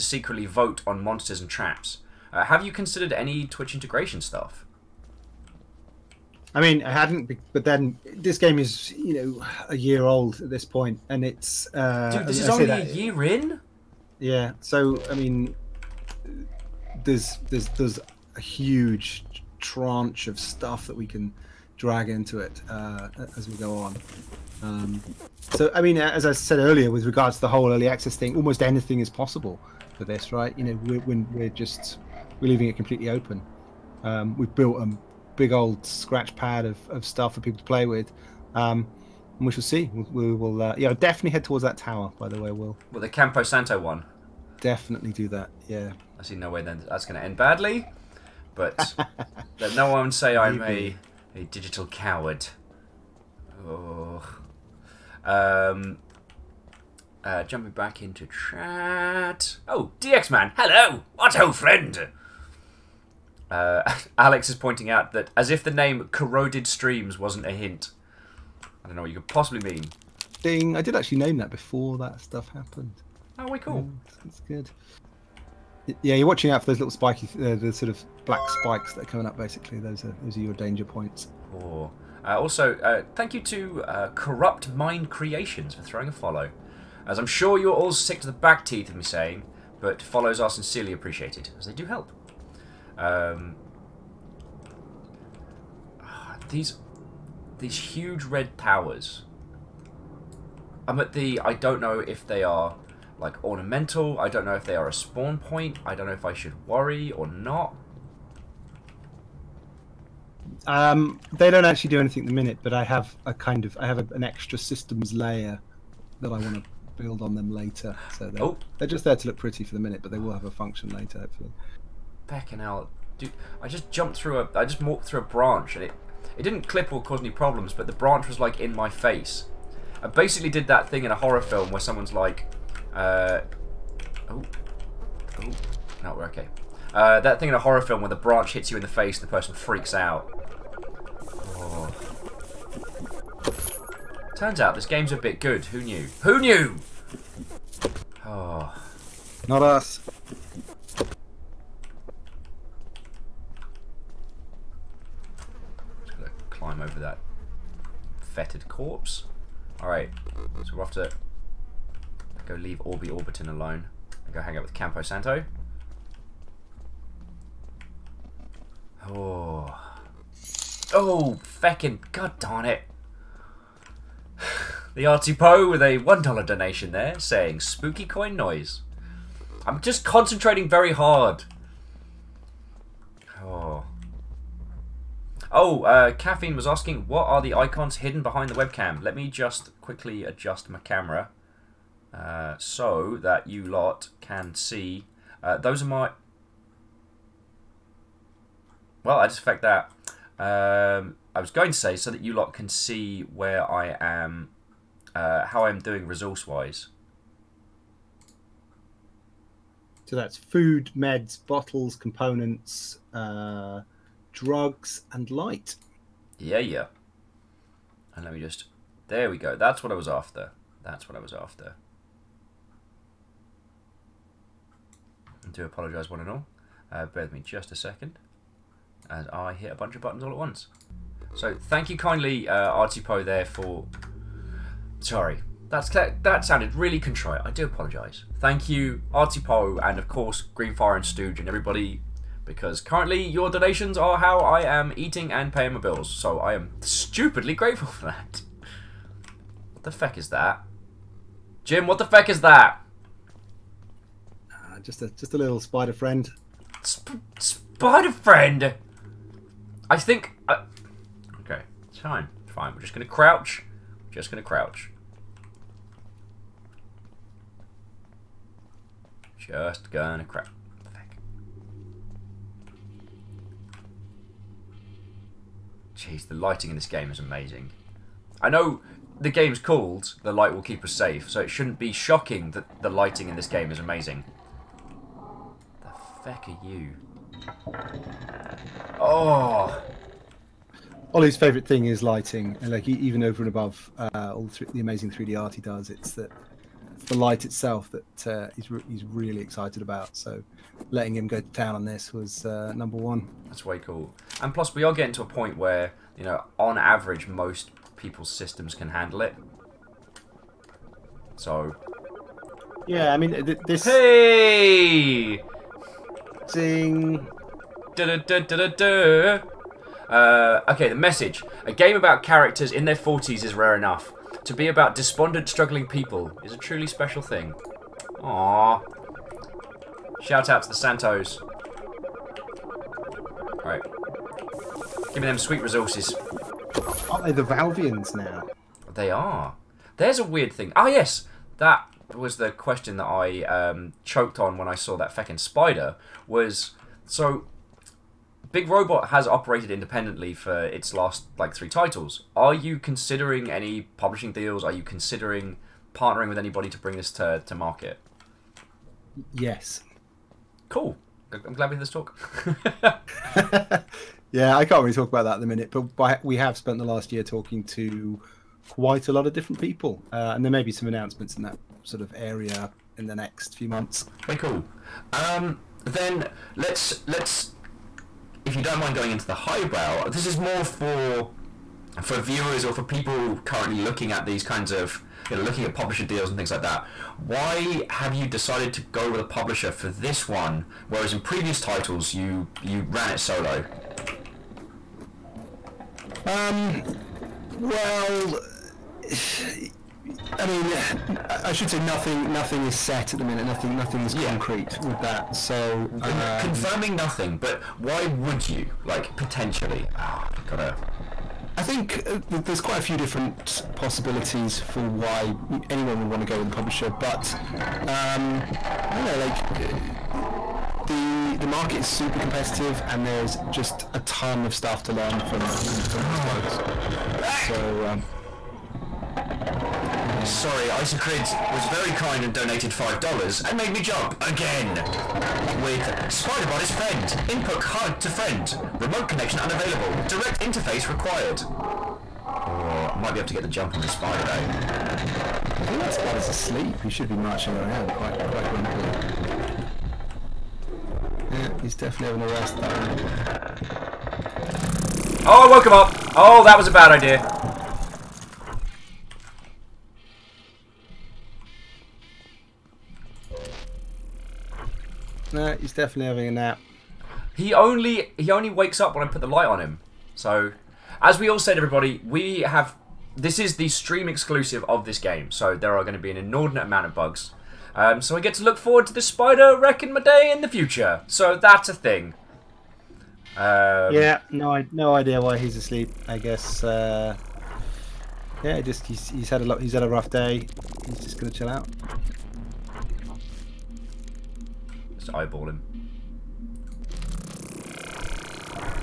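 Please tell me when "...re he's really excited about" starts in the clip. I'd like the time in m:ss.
4:58.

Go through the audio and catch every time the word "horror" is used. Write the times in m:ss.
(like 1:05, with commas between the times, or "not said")
2:11, 2:17.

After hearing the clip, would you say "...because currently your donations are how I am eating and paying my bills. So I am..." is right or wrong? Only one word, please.
right.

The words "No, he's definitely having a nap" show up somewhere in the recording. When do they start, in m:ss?
7:45.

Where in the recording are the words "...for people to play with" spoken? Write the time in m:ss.
0:37.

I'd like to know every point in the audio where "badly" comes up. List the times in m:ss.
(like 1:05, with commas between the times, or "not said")
0:47.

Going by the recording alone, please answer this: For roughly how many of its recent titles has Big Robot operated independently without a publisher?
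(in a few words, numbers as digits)
3.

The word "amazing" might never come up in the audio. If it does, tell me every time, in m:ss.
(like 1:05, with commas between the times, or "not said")
4:37, 4:43, 4:54.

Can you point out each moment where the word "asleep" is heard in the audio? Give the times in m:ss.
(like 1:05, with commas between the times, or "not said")
7:26, 8:05.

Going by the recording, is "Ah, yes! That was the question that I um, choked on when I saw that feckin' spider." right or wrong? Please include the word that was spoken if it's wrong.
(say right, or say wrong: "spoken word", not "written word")
right.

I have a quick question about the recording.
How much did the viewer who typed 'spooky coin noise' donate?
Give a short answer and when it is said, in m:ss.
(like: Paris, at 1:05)
$1, at 2:55.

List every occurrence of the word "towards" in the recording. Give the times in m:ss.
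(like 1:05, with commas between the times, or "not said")
0:41.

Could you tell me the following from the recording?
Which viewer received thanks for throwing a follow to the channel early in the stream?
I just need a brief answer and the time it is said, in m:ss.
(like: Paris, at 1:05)
Corrupt Mind Creations, at 1:24.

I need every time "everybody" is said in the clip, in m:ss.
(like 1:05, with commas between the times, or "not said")
4:01, 7:51.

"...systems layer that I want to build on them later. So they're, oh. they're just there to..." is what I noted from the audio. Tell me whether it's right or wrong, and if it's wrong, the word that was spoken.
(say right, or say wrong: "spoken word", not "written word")
right.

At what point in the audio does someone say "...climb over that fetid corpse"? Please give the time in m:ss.
2:36.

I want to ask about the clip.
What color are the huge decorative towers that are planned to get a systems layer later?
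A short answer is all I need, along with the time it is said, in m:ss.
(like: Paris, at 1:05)
Red, at 1:38.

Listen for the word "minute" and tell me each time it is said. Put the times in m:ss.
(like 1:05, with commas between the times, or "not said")
1:52, 1:59, 6:05, 6:43.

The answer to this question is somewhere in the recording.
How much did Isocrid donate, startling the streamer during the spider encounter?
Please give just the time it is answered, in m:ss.
7:12.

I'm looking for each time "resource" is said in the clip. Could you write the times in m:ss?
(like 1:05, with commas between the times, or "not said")
3:26, 5:35.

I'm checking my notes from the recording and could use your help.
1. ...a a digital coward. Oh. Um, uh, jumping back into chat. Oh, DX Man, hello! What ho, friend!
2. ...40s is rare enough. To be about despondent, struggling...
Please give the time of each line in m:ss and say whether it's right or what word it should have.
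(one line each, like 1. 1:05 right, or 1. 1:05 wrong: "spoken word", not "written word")
1. 0:50 right
2. 5:22 right.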